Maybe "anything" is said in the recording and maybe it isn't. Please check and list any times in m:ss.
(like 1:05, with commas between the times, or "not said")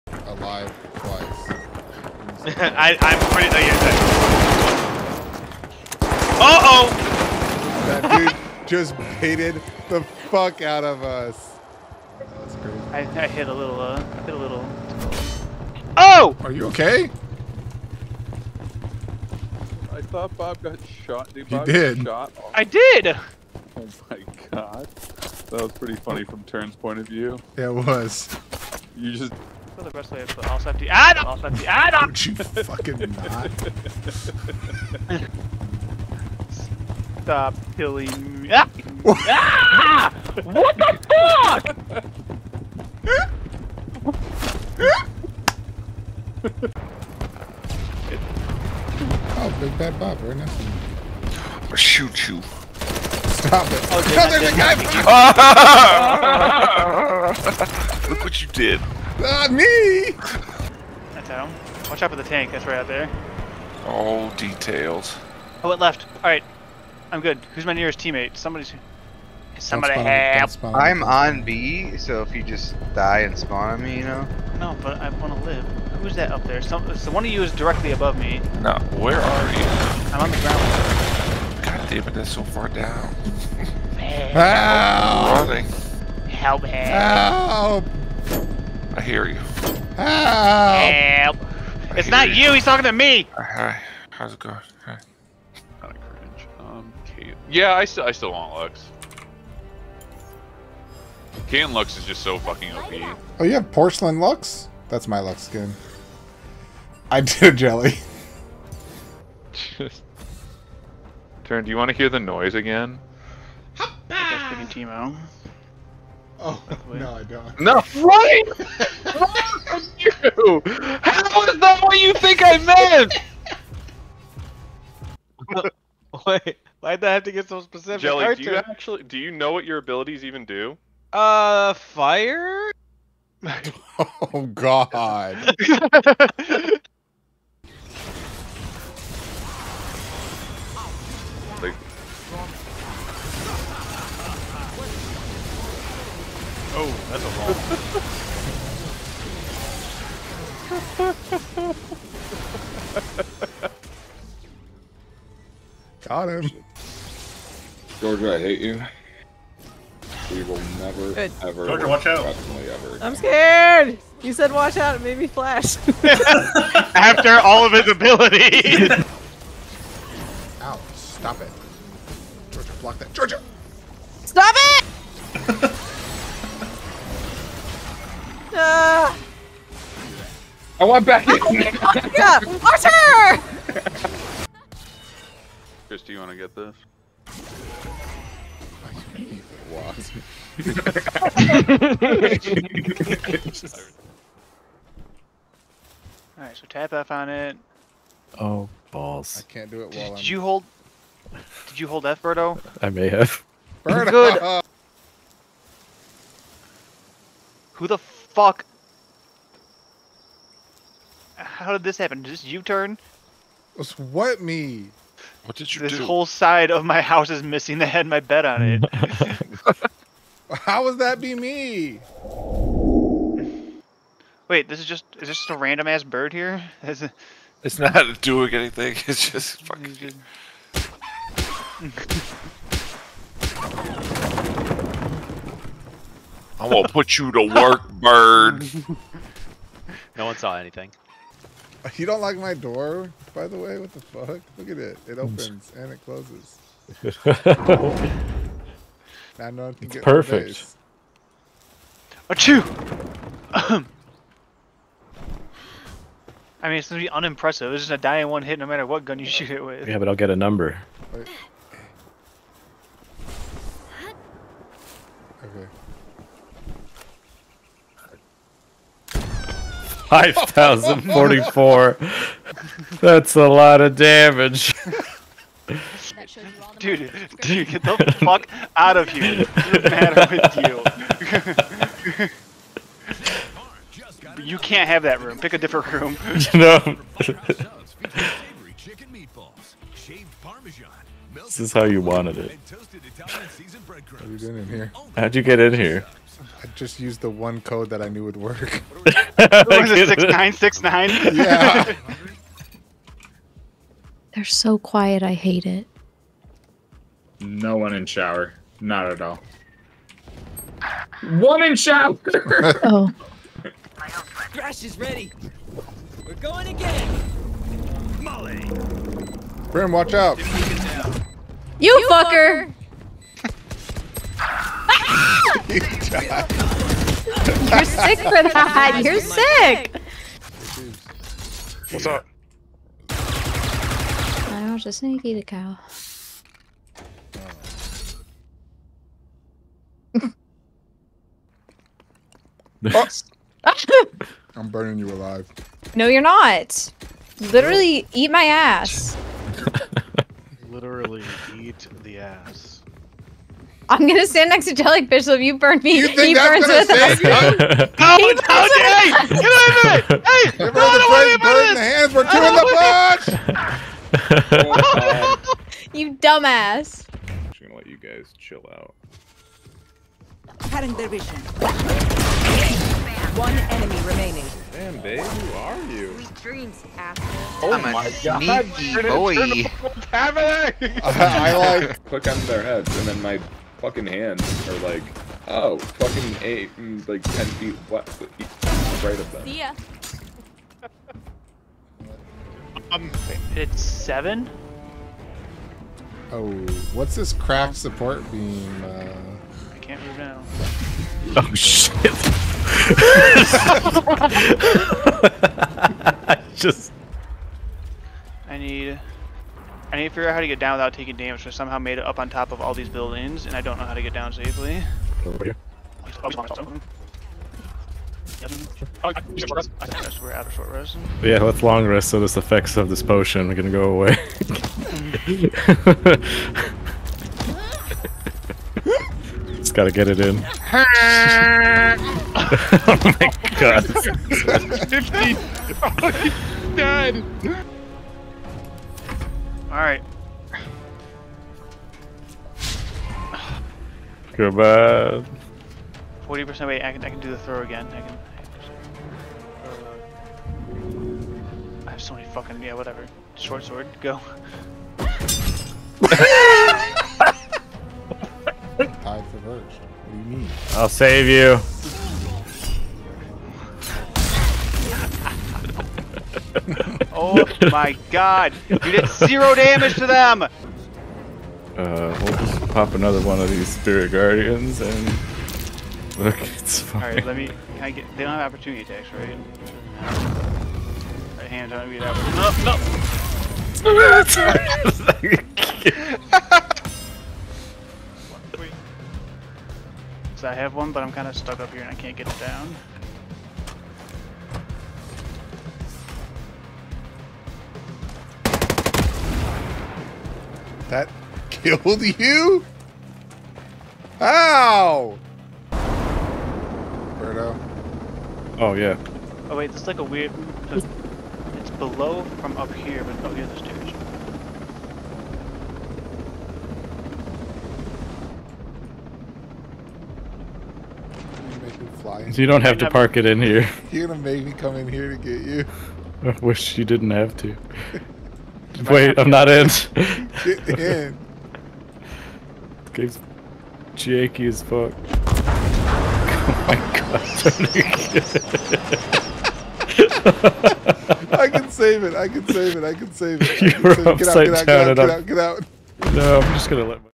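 3:48, 4:00.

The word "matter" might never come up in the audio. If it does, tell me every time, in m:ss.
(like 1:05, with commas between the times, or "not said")
4:18, 4:39.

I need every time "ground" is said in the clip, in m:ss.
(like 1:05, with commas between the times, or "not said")
1:20.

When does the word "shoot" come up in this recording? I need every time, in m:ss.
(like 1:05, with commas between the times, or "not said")
0:51, 4:19.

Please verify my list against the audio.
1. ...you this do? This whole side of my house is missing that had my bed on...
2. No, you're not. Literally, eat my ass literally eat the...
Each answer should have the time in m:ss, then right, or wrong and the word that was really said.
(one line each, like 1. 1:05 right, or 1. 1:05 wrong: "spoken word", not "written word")
1. 3:35 right
2. 5:45 right.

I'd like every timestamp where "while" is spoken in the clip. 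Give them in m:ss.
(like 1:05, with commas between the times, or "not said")
3:19.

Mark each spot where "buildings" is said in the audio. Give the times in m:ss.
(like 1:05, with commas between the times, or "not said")
6:52.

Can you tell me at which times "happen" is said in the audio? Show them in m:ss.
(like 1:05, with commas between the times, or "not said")
3:31.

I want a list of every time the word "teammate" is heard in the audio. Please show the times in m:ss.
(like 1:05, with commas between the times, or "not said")
1:07.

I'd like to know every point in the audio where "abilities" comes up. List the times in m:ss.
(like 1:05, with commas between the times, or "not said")
2:09, 2:47.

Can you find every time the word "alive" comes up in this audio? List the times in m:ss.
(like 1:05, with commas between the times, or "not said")
0:00, 5:45.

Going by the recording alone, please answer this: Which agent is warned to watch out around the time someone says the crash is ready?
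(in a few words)
Brim.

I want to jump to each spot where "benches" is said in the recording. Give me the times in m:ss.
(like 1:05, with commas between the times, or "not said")
not said.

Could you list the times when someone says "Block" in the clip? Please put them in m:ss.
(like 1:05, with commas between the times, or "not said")
2:52.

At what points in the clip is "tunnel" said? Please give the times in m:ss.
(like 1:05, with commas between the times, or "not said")
not said.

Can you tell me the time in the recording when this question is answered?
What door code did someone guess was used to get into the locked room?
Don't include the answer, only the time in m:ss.
5:00.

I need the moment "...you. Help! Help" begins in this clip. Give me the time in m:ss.
1:29.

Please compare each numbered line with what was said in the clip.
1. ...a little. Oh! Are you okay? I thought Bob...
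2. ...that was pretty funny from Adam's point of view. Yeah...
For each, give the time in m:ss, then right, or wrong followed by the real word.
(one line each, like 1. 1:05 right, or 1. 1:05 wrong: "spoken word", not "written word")
1. 0:14 right
2. 0:24 wrong: "Turn", not "Adam".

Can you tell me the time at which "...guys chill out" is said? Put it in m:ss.
6:07.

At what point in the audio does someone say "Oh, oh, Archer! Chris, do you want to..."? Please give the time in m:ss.
3:01.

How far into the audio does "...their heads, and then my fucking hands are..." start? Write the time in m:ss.
6:22.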